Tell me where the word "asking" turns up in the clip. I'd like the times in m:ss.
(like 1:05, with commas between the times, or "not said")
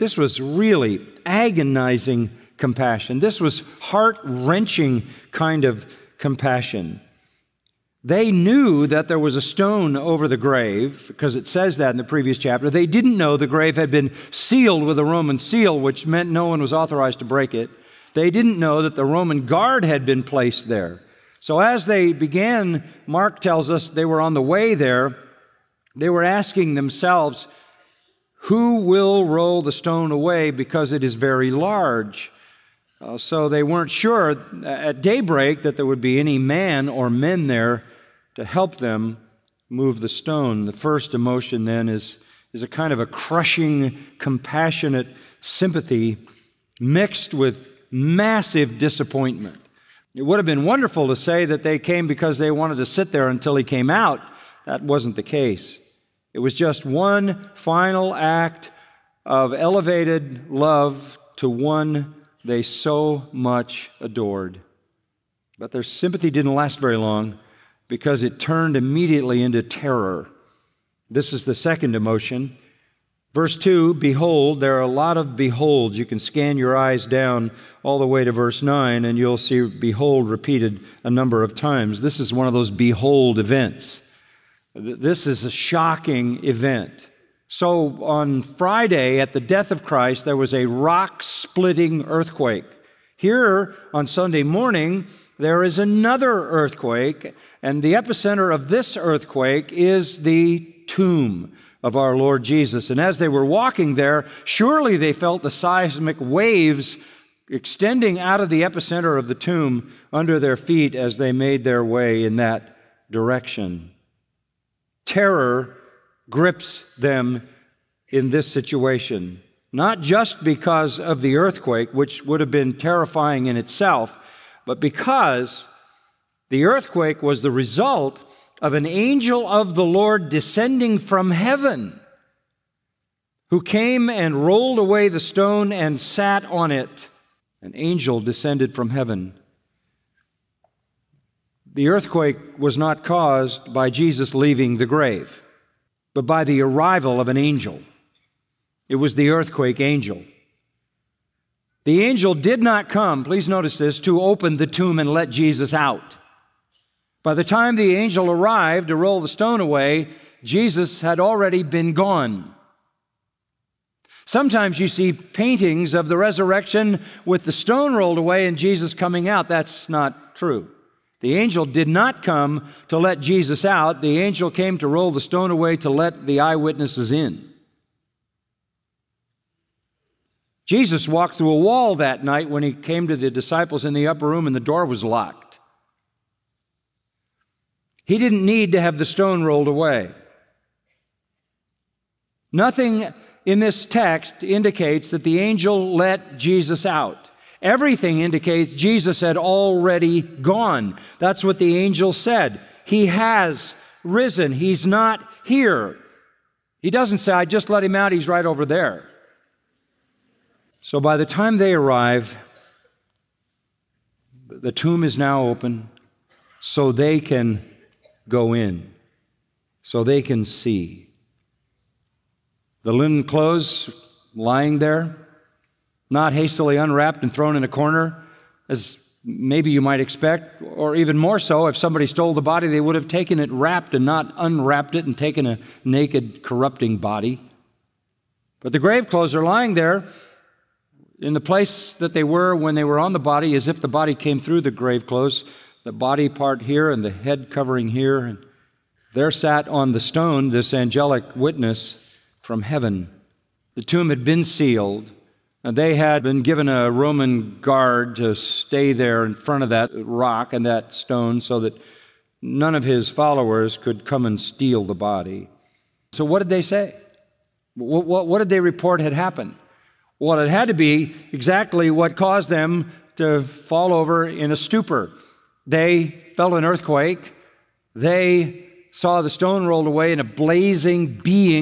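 0:26.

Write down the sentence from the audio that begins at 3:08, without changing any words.
He didn't need to have the stone rolled away.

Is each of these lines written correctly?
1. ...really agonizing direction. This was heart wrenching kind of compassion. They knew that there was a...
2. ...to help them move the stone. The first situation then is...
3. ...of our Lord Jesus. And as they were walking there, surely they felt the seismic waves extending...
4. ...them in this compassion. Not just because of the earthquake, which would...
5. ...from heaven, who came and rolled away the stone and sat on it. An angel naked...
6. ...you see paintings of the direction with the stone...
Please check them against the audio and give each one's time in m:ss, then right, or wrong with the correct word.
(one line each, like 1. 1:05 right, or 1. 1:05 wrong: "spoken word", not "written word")
1. 0:00 wrong: "compassion", not "direction"
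2. 0:38 wrong: "emotion", not "situation"
3. 1:41 right
4. 1:56 wrong: "situation", not "compassion"
5. 2:10 wrong: "descended", not "naked"
6. 2:44 wrong: "resurrection", not "direction".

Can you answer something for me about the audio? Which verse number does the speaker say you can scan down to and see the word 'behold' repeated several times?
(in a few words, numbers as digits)
9.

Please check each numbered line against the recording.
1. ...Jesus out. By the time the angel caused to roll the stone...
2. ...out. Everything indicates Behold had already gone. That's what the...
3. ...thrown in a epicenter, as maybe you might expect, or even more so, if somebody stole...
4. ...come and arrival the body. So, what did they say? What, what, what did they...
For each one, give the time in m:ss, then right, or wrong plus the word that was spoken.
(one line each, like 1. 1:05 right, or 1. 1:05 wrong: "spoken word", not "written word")
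1. 2:35 wrong: "arrived", not "caused"
2. 3:16 wrong: "Jesus", not "Behold"
3. 3:47 wrong: "corner", not "epicenter"
4. 4:24 wrong: "steal", not "arrival".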